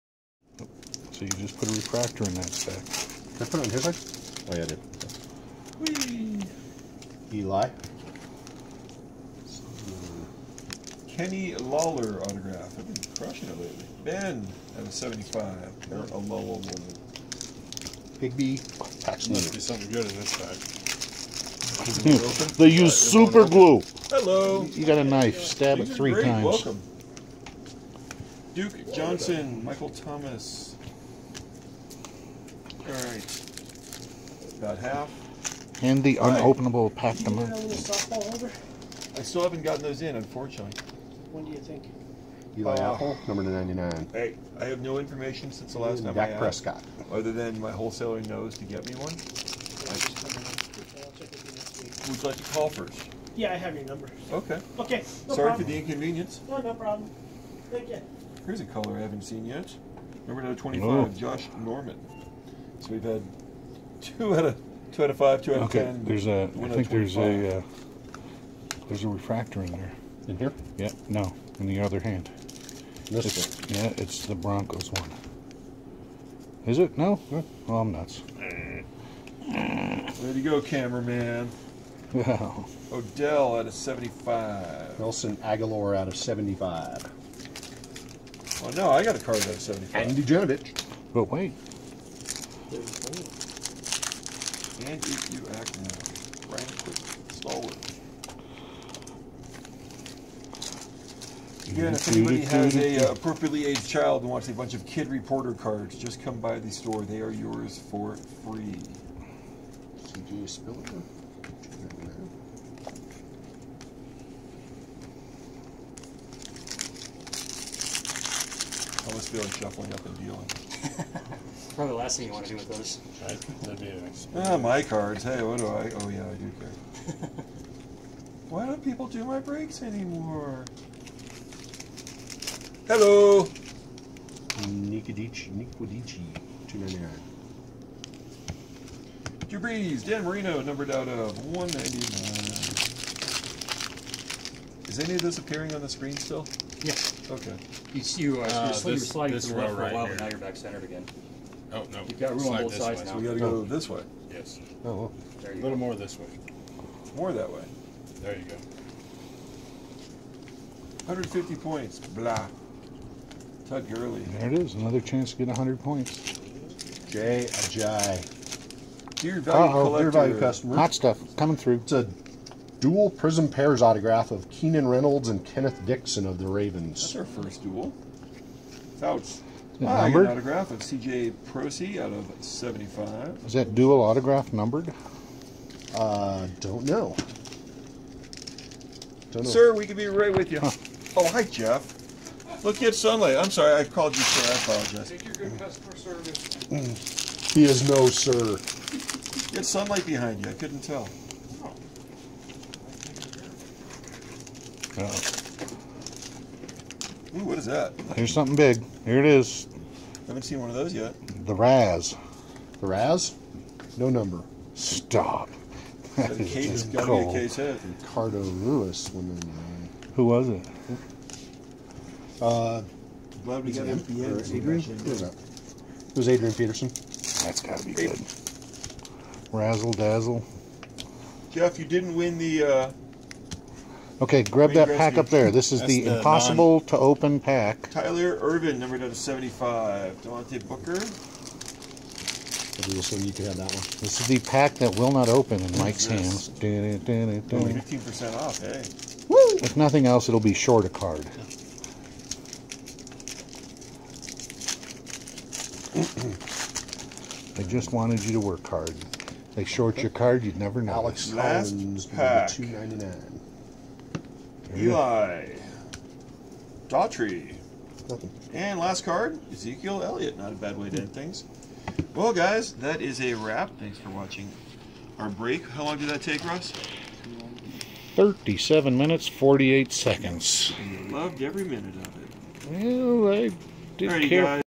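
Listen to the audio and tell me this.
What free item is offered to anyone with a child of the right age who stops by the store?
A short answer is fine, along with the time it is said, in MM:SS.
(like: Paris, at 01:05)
kid reporter cards, at 01:44.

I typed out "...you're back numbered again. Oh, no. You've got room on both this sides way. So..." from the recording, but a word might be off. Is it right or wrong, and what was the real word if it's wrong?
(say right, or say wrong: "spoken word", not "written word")
wrong: "centered", not "numbered".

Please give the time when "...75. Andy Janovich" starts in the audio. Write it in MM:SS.
01:29.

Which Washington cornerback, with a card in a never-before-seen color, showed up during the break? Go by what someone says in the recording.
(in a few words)
Josh Norman.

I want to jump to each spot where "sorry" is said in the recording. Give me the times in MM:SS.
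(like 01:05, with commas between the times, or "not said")
00:55, 03:13.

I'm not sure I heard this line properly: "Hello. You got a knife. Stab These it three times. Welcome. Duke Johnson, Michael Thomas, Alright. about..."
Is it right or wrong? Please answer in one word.
right.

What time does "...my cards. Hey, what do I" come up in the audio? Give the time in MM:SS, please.
02:04.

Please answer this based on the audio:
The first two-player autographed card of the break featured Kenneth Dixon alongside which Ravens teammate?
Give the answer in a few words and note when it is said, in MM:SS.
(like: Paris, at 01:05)
Keenan Reynolds, at 02:54.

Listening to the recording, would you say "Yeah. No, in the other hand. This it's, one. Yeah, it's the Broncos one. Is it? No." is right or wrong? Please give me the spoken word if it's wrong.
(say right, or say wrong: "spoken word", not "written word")
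right.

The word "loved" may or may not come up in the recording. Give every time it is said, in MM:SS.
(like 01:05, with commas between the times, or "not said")
04:41.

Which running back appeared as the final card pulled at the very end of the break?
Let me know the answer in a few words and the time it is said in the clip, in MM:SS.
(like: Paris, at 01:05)
Ezekiel Elliott, at 04:29.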